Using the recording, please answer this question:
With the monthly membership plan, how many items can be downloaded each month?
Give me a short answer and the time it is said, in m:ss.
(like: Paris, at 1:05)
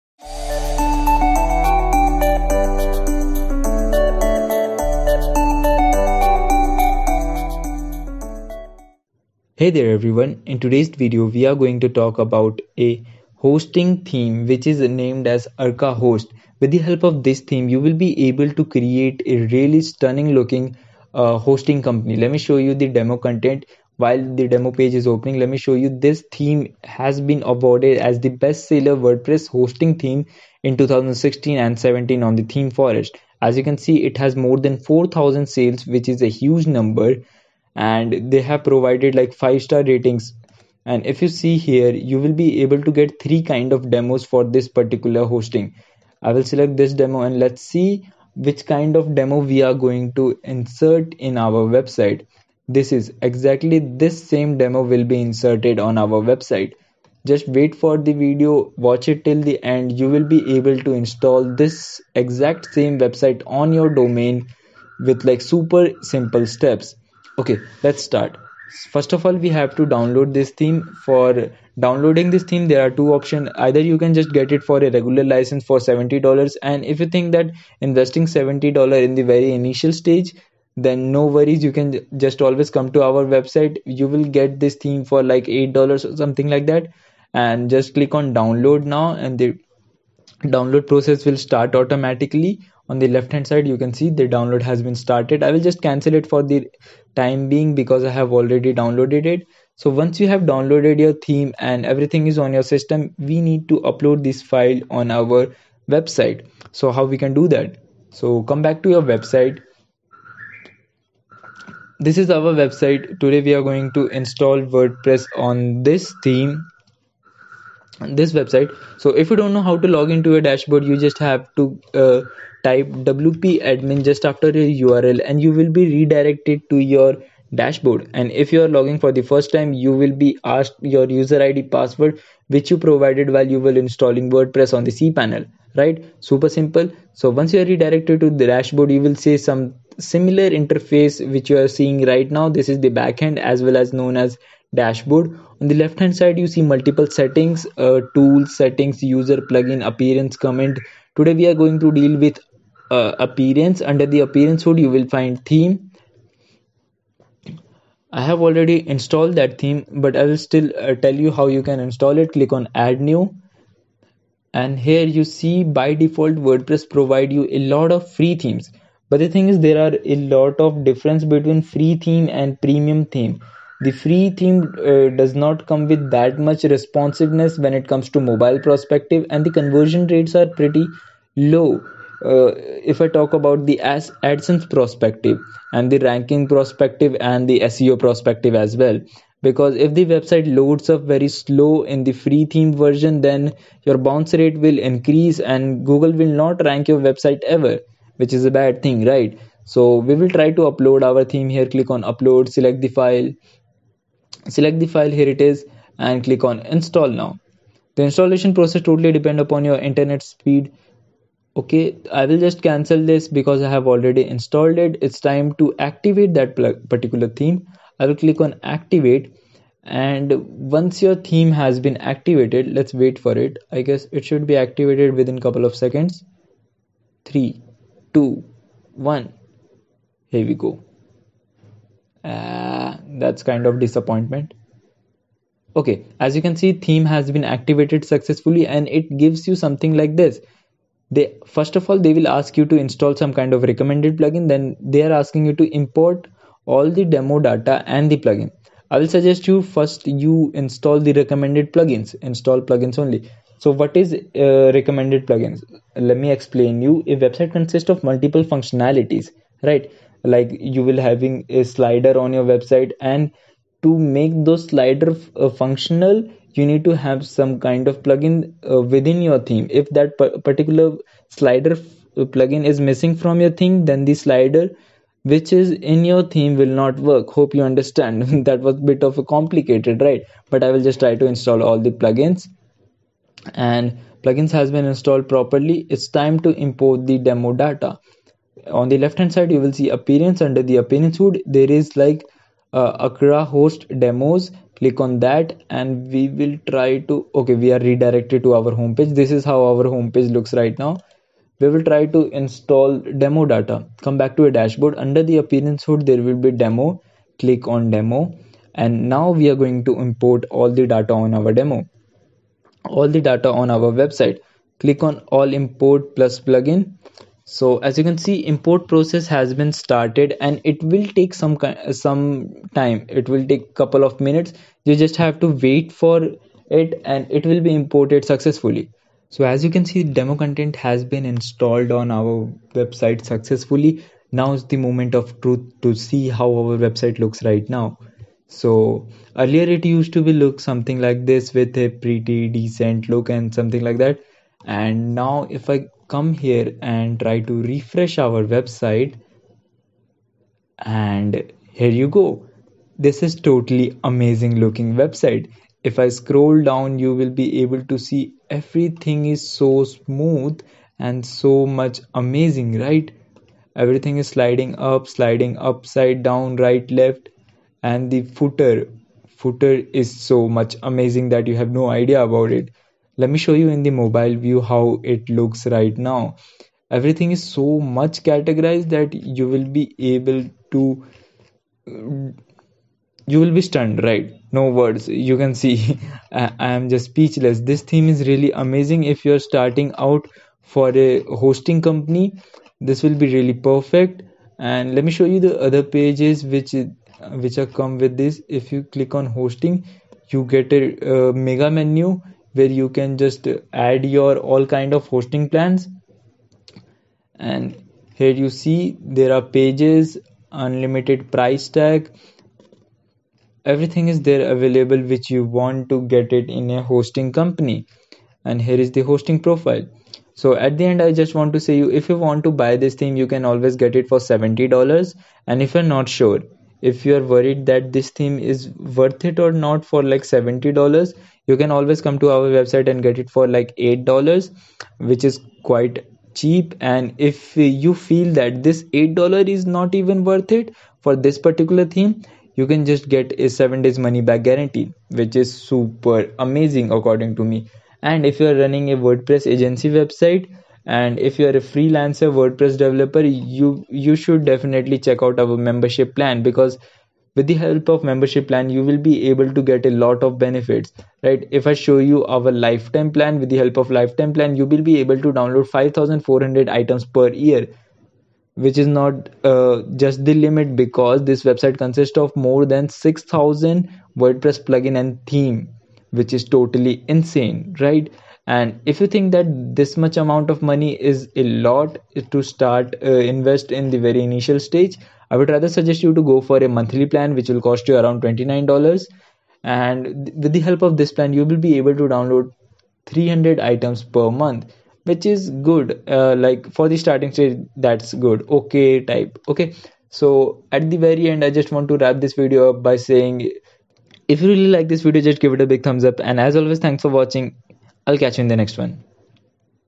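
300, at 8:13.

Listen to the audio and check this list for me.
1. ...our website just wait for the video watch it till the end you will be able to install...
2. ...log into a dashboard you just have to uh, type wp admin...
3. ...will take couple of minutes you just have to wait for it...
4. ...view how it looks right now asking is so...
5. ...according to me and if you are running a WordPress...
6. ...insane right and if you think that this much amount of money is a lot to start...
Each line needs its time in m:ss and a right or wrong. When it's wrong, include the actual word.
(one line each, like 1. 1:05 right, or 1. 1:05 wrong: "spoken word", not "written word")
1. 0:55 right
2. 1:59 right
3. 5:23 right
4. 6:14 wrong: "everything", not "asking"
5. 7:26 right
6. 7:57 right.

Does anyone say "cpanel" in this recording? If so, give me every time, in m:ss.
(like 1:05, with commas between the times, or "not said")
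2:14.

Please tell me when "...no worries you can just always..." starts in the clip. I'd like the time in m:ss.
1:21.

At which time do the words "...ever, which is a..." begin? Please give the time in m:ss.
3:17.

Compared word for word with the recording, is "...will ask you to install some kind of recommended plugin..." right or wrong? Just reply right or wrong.
right.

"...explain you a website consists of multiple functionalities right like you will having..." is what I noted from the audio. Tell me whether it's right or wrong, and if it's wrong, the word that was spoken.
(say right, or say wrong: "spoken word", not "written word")
right.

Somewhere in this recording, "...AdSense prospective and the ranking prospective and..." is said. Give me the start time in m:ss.
3:03.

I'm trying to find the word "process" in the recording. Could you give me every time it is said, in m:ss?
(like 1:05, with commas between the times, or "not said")
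1:30, 3:28, 5:18.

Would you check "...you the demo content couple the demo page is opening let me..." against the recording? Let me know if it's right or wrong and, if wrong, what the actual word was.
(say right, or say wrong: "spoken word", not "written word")
wrong: "while", not "couple".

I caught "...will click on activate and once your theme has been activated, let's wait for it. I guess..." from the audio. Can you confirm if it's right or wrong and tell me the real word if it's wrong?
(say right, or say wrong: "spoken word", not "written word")
right.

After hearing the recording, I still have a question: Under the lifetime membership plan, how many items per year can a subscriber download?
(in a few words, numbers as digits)
5400.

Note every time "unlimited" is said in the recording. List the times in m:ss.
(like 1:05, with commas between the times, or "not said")
6:50.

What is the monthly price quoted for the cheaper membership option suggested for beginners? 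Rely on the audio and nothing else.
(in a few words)
$29.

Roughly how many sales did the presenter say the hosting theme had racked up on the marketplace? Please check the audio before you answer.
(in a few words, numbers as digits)
4000.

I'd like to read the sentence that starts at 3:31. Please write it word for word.
Okay, I will just cancel this because I have already installed it.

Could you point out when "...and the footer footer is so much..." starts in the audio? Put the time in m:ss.
6:07.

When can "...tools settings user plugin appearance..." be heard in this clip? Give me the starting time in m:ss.
2:28.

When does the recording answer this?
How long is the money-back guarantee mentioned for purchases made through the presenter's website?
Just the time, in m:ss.
7:23.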